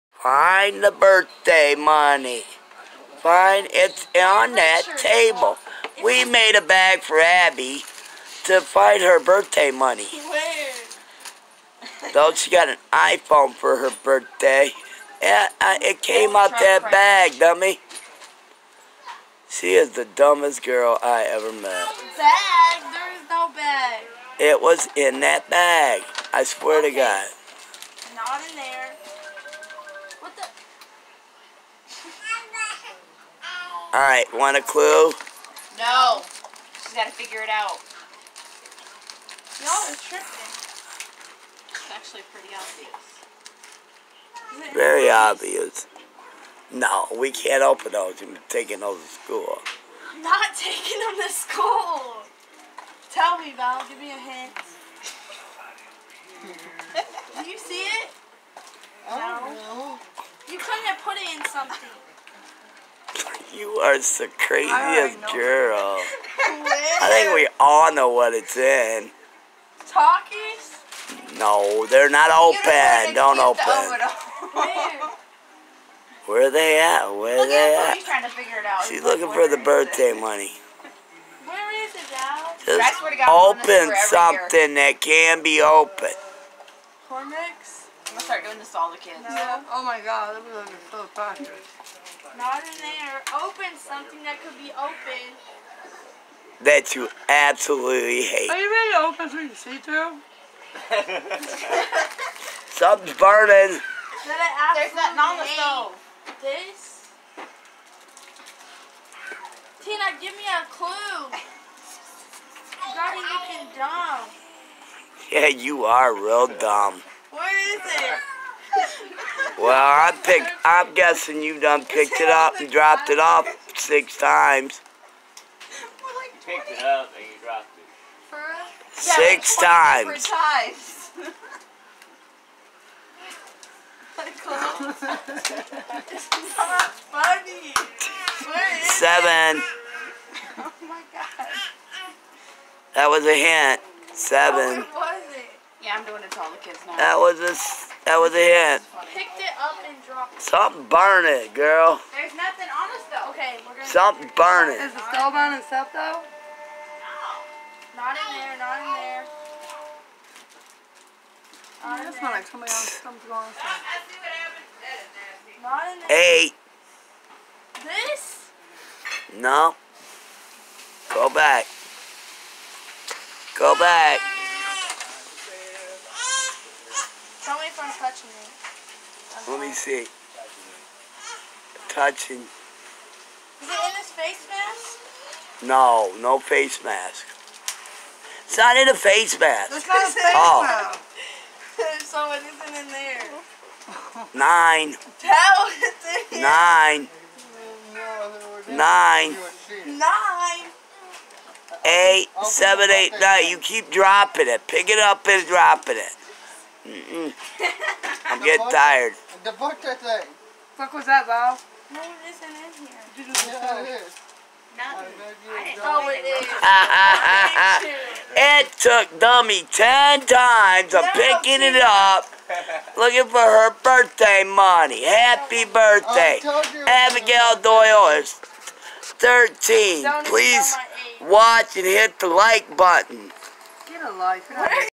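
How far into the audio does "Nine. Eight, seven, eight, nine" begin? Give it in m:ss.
3:19.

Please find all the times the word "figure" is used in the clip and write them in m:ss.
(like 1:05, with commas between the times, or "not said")
0:37, 1:18.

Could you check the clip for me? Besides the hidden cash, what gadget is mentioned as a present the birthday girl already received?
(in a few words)
iPhone.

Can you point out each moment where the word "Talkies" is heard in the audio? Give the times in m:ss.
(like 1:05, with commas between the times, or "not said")
1:09.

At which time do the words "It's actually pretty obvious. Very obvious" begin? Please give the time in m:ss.
0:41.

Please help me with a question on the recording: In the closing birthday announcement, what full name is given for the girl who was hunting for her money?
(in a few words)
Abigail Doyle.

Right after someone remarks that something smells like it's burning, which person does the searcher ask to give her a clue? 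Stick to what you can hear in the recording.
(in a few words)
Tina.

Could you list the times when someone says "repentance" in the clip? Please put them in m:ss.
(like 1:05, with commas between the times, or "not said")
not said.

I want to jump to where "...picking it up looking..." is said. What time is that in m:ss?
3:41.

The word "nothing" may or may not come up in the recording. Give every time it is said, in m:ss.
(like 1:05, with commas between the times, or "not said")
1:44, 2:32.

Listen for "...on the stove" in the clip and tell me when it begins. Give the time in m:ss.
1:45.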